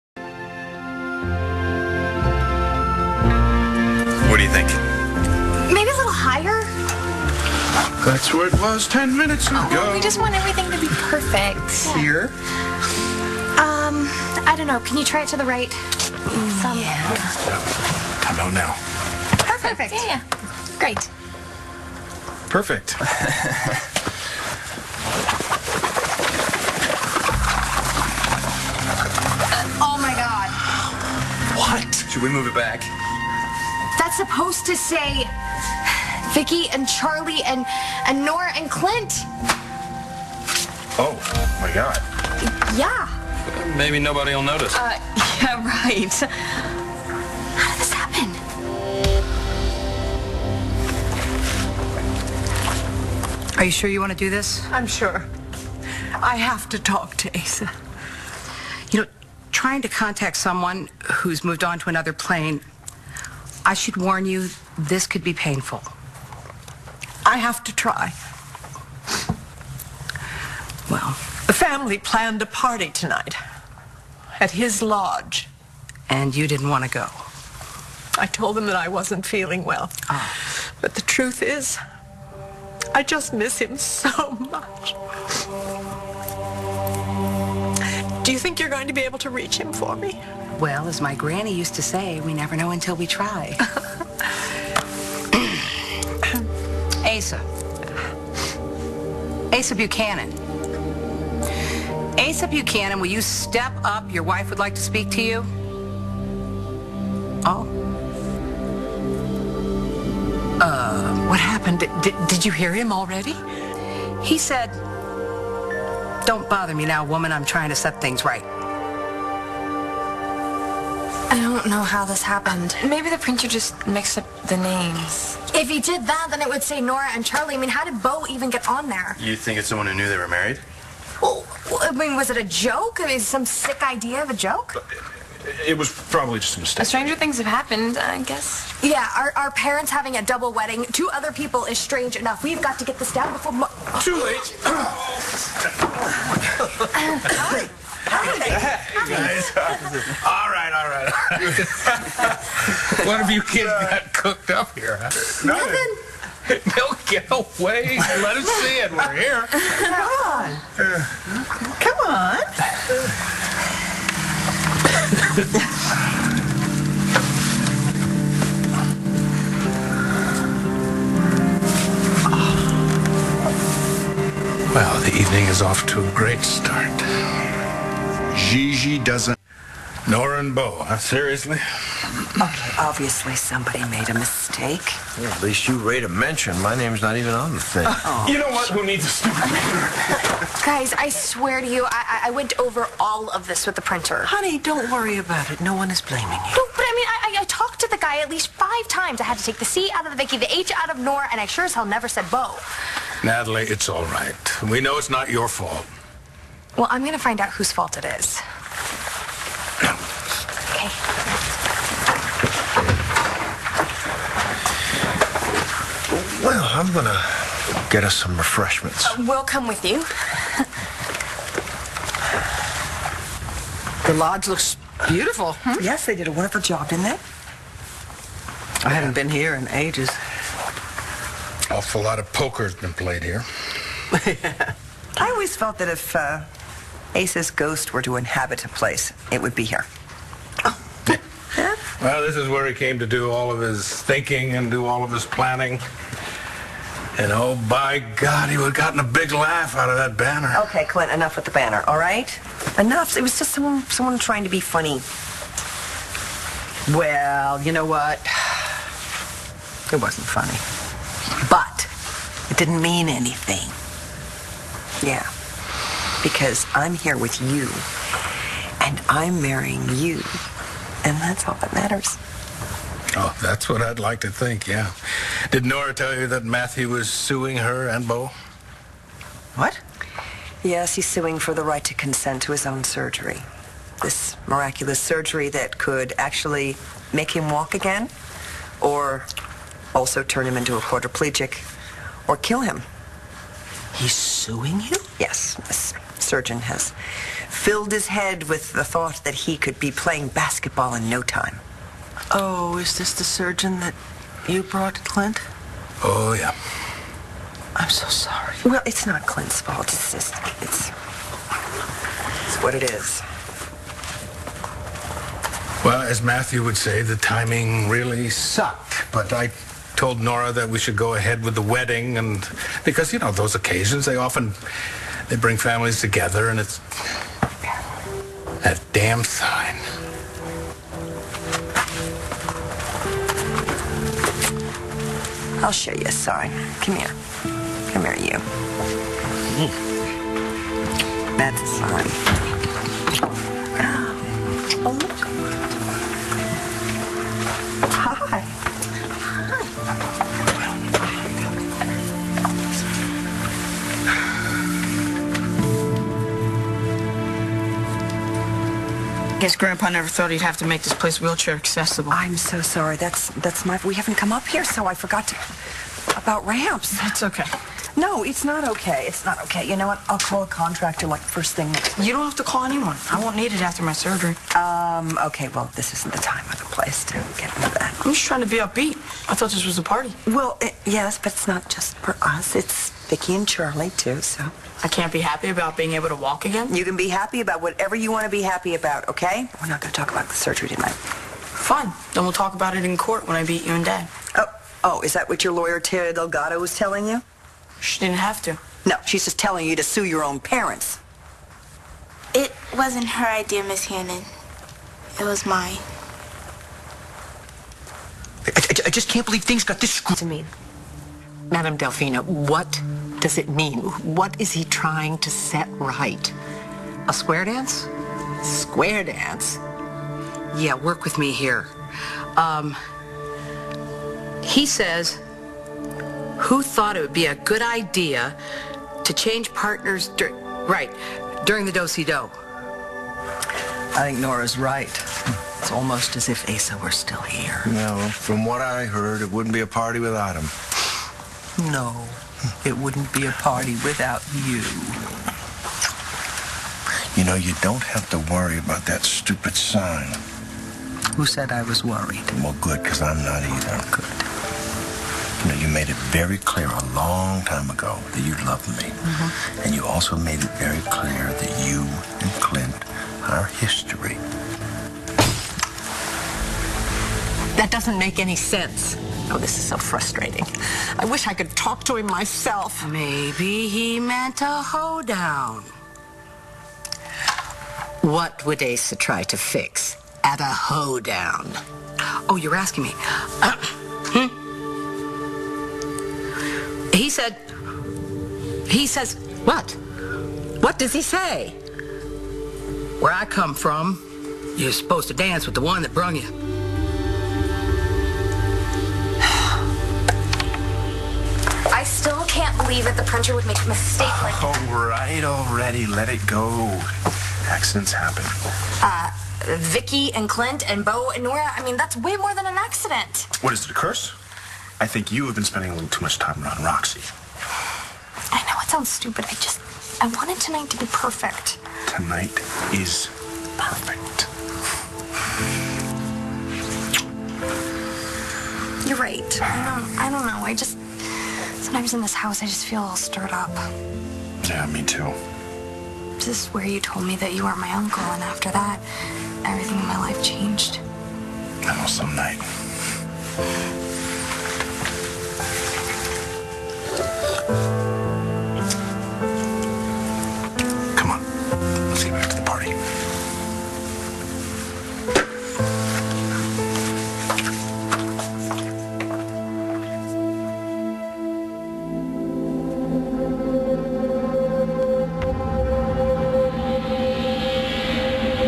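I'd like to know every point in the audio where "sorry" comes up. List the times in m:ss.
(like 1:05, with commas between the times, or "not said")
5:08, 6:02.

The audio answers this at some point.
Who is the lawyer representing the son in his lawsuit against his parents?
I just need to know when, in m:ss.
6:35.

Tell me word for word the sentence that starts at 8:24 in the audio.
All right, already, let it go.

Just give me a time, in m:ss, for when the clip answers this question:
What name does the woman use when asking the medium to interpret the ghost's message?
6:51.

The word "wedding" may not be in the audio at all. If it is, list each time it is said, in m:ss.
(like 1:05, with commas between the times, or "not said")
2:20, 5:21.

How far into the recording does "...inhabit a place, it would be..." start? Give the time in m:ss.
3:58.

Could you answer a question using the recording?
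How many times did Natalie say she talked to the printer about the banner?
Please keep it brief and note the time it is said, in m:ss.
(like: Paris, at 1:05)
5, at 3:18.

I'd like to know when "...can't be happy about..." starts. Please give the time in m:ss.
6:24.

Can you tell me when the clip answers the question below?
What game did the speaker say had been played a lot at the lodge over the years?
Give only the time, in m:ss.
3:52.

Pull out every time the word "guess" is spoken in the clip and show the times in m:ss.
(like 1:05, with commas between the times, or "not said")
2:18, 5:59.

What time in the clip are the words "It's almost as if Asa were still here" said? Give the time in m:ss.
7:15.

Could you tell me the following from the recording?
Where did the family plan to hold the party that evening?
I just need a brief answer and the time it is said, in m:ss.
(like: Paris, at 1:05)
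His lodge, at 1:14.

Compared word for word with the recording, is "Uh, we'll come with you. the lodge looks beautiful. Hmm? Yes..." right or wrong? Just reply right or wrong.
right.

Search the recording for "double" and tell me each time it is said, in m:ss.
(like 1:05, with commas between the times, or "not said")
2:20.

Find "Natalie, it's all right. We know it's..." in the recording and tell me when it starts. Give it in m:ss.
3:23.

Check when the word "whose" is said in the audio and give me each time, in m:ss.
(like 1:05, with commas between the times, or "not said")
3:27.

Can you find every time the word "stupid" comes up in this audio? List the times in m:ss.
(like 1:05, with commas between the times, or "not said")
3:09, 7:29, 8:38.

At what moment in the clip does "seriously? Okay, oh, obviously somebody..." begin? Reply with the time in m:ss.
3:00.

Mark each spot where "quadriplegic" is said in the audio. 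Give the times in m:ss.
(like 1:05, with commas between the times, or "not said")
4:50.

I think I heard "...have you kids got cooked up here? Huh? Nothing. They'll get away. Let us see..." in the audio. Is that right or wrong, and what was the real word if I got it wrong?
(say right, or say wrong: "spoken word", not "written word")
right.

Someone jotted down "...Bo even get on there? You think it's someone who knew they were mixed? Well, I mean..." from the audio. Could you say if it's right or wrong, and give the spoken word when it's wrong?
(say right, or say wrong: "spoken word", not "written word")
wrong: "married", not "mixed".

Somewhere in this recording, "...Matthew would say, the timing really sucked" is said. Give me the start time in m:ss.
5:16.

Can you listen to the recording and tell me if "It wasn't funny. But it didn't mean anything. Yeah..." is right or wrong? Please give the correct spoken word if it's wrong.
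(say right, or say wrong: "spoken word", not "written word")
right.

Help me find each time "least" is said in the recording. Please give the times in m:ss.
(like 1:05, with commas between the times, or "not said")
3:05, 3:18.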